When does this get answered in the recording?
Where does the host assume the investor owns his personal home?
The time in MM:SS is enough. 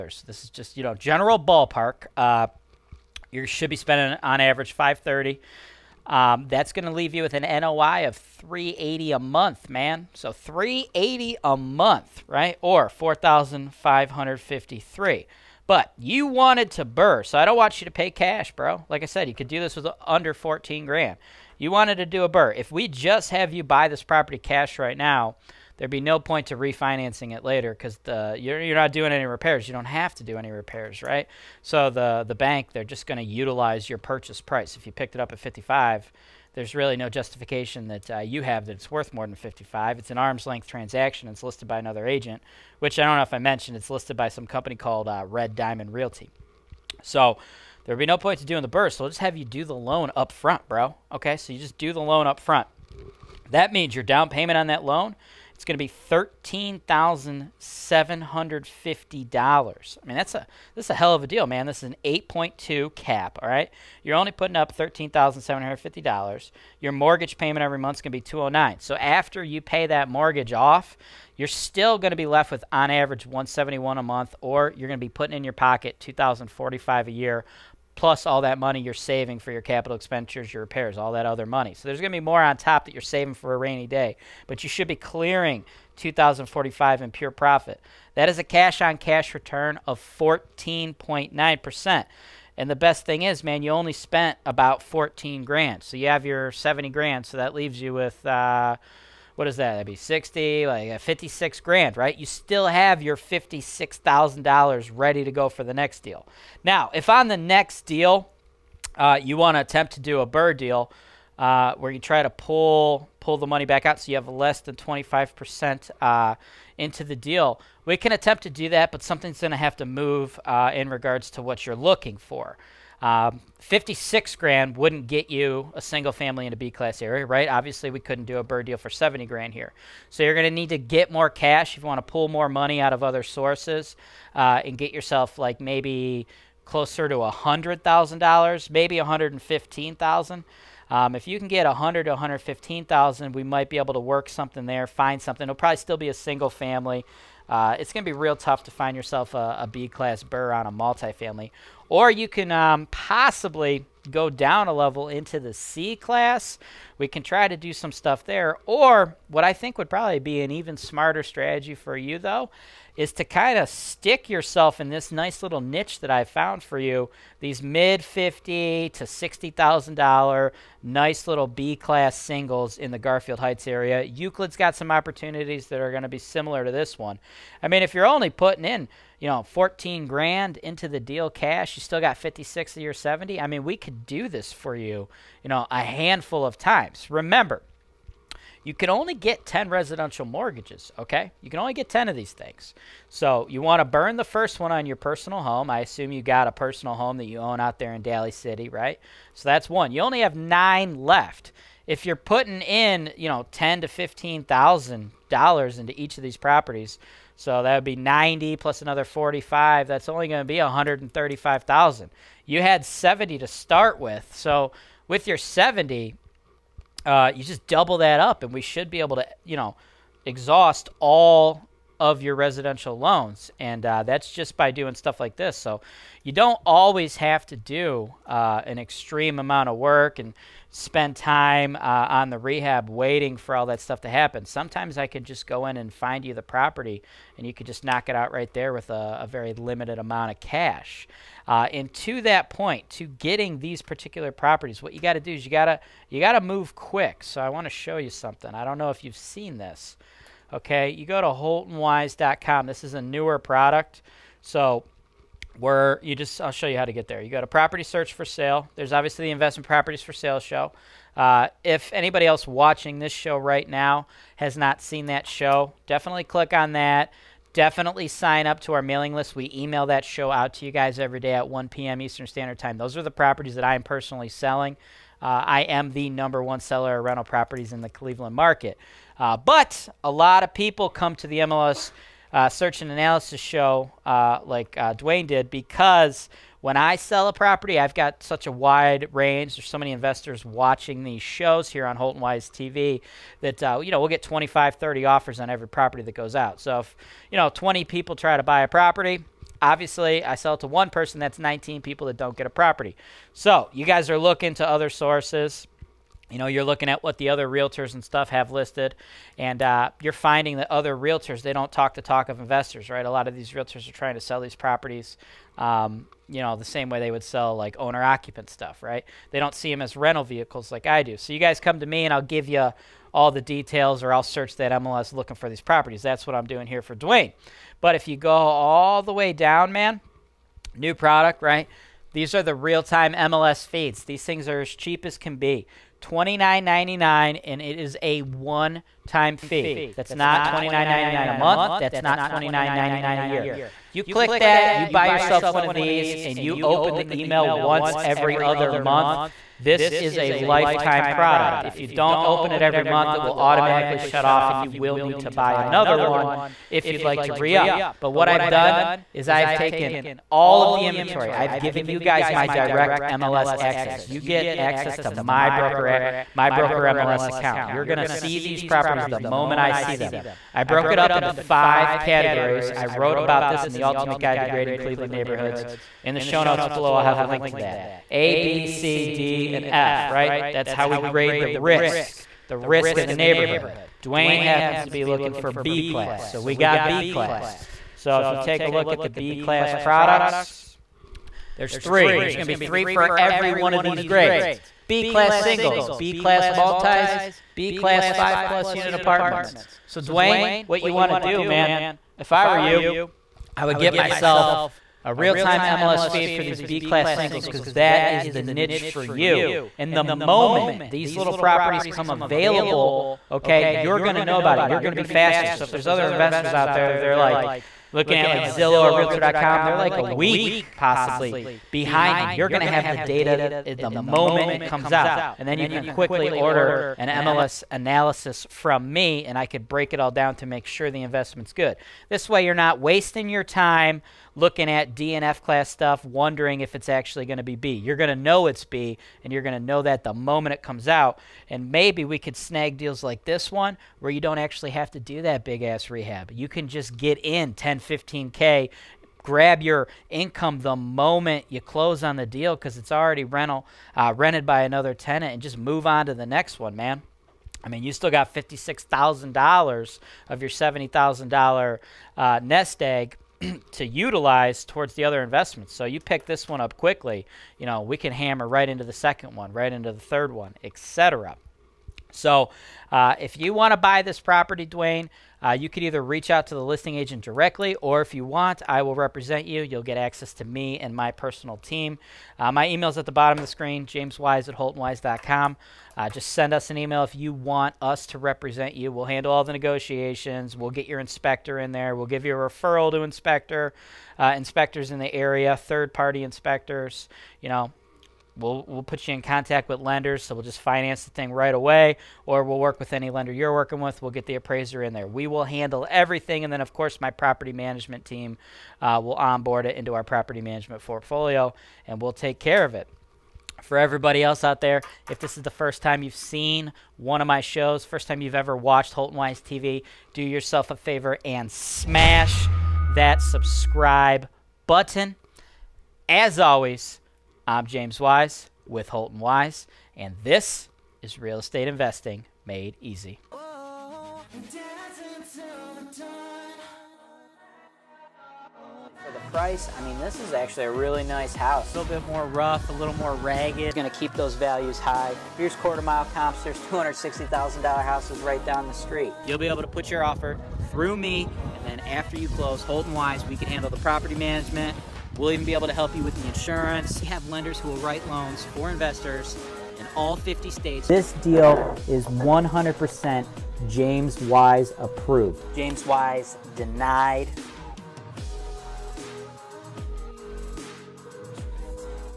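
03:18.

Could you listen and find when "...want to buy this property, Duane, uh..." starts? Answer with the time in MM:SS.
07:53.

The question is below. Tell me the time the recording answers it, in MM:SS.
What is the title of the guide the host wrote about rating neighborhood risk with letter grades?
06:13.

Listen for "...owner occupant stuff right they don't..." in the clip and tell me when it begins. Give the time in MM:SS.
05:17.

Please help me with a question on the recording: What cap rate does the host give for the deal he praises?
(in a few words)
8.2 cap.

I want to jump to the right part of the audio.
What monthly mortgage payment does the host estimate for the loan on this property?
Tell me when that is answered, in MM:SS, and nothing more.
01:08.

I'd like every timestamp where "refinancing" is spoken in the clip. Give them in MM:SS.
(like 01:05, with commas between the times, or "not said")
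00:26.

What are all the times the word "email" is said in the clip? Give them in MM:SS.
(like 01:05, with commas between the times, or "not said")
04:29, 05:47, 08:02, 08:06.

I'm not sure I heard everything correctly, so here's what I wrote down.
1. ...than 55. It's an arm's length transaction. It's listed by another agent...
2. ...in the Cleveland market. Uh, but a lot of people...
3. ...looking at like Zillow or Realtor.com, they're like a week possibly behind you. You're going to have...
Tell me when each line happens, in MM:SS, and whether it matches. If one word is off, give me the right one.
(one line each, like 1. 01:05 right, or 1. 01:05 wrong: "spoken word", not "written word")
1. 00:39 right
2. 04:37 right
3. 06:57 right.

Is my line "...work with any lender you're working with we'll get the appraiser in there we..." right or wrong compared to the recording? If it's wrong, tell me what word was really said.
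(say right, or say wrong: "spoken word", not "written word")
right.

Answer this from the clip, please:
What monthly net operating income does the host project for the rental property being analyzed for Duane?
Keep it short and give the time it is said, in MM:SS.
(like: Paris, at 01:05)
380 a month, at 00:07.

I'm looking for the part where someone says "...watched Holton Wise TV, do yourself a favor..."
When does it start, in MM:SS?
08:38.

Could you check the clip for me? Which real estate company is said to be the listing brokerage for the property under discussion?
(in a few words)
Red Diamond Realty.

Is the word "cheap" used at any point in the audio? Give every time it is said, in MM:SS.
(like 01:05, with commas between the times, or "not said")
05:34.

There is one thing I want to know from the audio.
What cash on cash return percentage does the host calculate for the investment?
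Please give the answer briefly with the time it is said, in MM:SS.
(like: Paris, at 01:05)
14.9%, at 01:29.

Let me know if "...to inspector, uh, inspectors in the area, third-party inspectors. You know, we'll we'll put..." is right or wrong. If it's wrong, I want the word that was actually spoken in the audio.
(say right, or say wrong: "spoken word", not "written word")
right.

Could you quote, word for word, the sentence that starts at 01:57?
We can attempt to do that, but something's going to have to move uh, in regards to what you're looking for.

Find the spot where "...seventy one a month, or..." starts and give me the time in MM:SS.
01:13.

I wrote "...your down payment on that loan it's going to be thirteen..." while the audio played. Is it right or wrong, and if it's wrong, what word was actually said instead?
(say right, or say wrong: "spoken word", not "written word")
right.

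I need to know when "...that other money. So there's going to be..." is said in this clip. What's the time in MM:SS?
01:21.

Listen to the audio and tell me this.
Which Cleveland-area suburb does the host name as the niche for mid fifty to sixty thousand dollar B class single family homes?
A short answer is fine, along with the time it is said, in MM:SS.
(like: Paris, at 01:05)
Garfield Heights, at 02:52.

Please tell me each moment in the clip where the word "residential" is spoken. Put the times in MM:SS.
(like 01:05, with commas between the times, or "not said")
03:09, 03:42.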